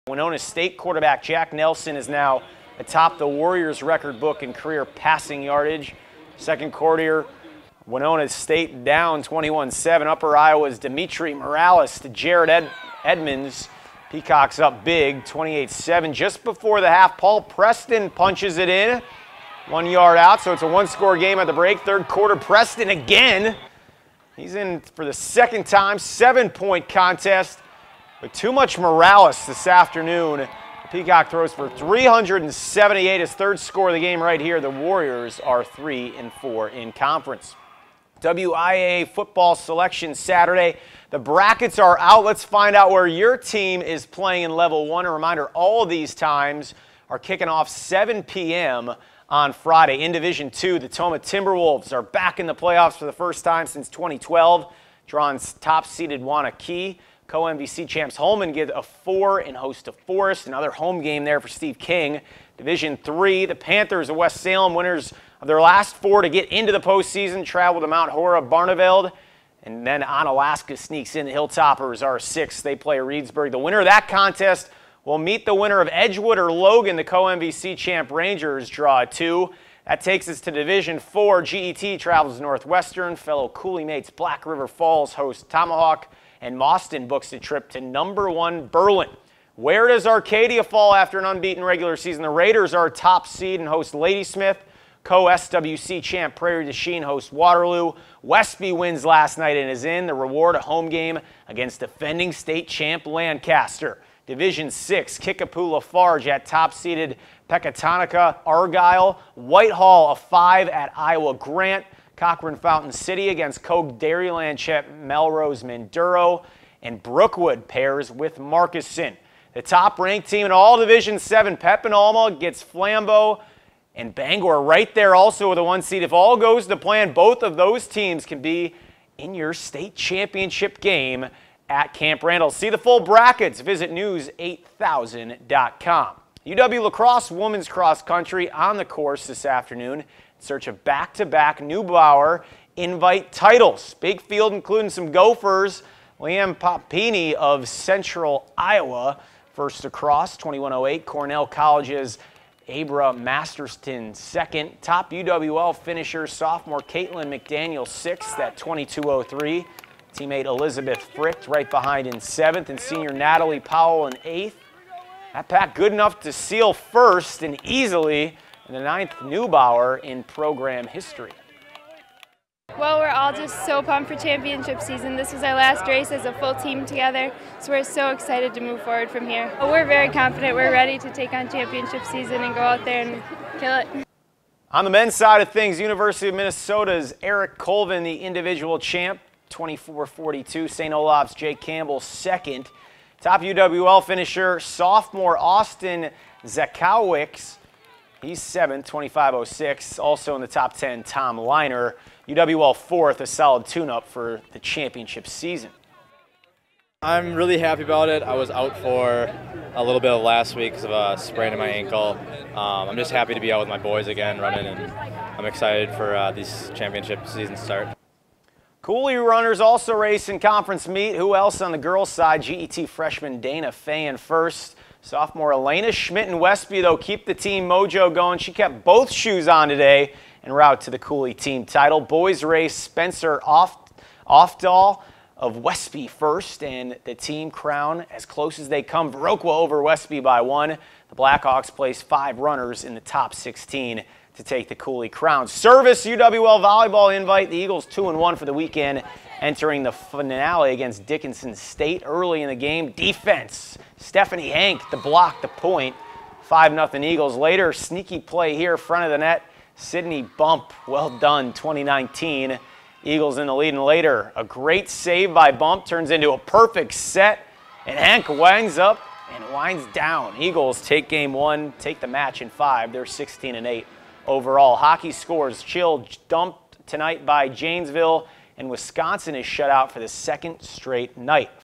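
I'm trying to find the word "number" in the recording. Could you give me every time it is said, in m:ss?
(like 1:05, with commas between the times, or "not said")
1:27.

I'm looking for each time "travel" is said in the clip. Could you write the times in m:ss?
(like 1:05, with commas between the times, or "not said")
1:07, 1:21.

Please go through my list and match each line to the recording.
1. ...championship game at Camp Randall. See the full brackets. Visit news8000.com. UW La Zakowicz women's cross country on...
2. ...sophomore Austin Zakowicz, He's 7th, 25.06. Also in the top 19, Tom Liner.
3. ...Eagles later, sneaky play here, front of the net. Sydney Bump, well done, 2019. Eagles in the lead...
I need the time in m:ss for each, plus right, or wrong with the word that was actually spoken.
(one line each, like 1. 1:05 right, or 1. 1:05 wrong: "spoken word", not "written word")
1. 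2:09 wrong: "Crosse", not "Zakowicz"
2. 3:14 wrong: "10", not "19"
3. 4:17 right.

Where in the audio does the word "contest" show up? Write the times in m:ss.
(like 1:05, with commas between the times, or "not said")
0:26, 1:14.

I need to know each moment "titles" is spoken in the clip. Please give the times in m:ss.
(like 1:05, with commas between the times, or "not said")
2:23, 3:51.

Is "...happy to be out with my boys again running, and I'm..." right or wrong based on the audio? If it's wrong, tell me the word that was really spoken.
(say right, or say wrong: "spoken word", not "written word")
right.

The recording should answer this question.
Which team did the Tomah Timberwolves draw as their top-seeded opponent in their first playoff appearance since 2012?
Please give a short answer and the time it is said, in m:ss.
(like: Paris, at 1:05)
Waunakee, at 0:56.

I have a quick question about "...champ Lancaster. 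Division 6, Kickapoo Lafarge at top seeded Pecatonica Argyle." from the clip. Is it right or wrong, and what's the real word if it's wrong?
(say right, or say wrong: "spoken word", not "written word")
right.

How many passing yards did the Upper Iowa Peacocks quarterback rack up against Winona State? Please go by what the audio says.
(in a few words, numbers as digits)
378.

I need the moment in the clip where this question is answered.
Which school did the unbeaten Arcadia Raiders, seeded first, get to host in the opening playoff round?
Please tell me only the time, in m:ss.
1:33.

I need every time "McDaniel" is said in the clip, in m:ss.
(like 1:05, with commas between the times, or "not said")
2:37.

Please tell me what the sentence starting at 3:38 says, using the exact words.
Coulee runners also race in conference meet.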